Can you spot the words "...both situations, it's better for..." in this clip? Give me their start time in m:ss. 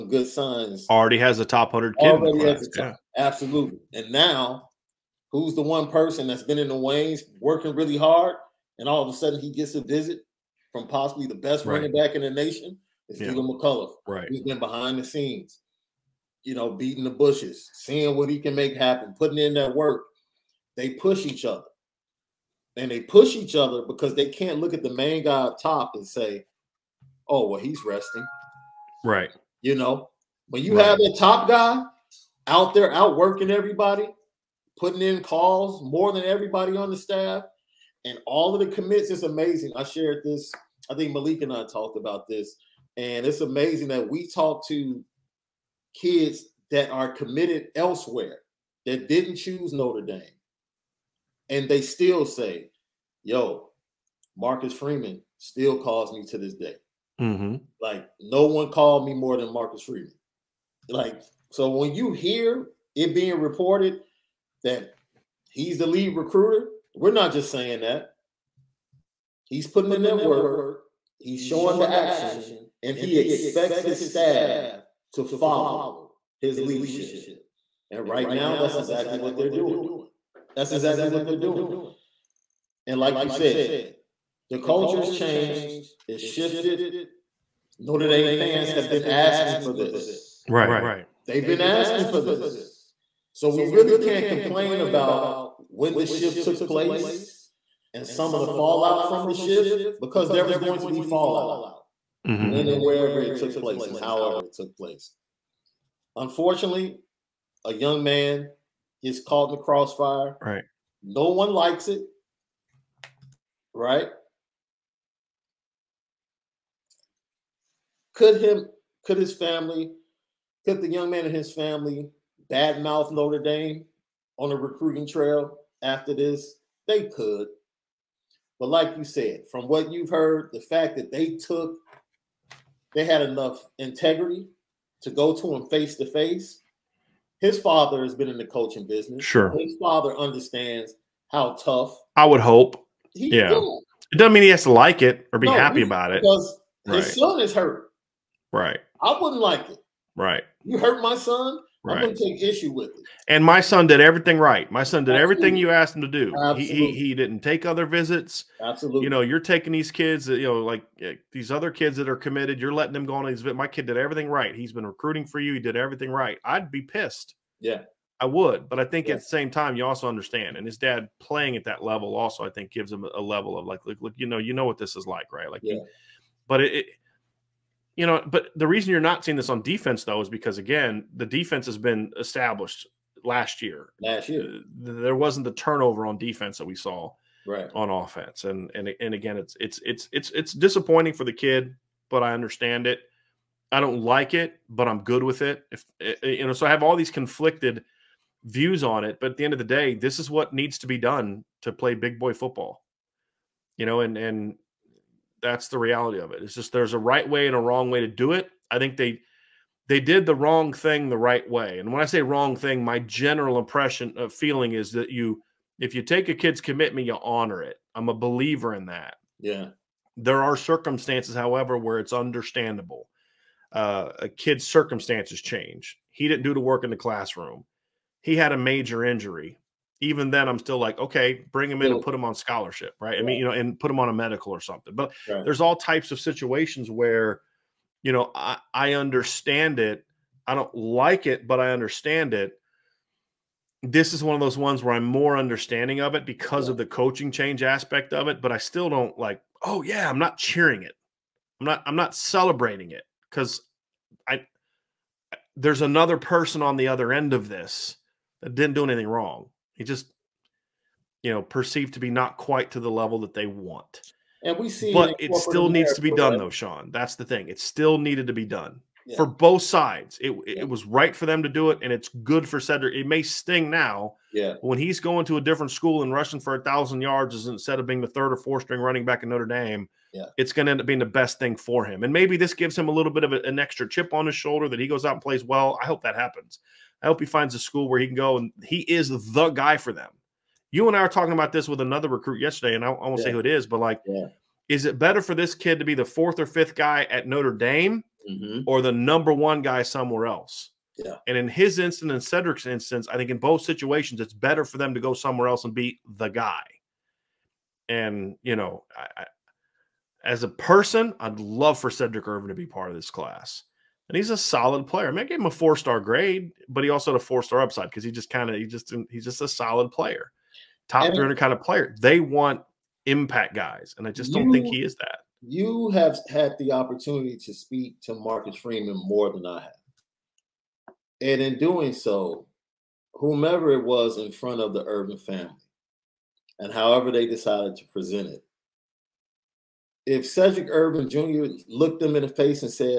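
5:03.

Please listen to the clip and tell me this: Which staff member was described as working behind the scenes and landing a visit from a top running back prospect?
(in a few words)
McCullough.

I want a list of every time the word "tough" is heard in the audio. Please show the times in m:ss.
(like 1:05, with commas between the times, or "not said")
2:21.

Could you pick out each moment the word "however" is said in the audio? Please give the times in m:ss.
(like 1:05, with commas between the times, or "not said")
1:43, 3:41, 5:36.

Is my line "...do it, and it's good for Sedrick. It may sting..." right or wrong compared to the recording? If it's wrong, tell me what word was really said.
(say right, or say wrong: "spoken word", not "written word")
right.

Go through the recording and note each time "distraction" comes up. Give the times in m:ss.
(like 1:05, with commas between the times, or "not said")
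not said.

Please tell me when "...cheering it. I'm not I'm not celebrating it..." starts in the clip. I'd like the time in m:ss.
4:10.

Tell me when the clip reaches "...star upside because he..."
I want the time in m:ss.
5:17.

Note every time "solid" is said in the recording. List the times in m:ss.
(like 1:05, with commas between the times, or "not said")
5:14, 5:19.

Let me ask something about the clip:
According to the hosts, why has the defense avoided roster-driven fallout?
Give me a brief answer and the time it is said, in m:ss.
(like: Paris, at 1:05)
Established last year, at 3:02.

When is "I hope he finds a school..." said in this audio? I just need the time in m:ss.
4:47.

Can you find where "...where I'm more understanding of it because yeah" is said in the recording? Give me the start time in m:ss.
4:04.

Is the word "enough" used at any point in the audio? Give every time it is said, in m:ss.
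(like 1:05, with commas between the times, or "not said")
2:13.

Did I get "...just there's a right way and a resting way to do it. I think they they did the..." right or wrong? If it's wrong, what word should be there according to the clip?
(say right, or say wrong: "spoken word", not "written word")
wrong: "wrong", not "resting".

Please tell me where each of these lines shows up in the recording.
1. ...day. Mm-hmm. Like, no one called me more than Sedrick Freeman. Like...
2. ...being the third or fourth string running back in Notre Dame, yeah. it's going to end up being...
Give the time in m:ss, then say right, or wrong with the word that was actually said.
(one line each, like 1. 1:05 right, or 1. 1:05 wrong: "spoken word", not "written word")
1. 0:56 wrong: "Marcus", not "Sedrick"
2. 4:37 right.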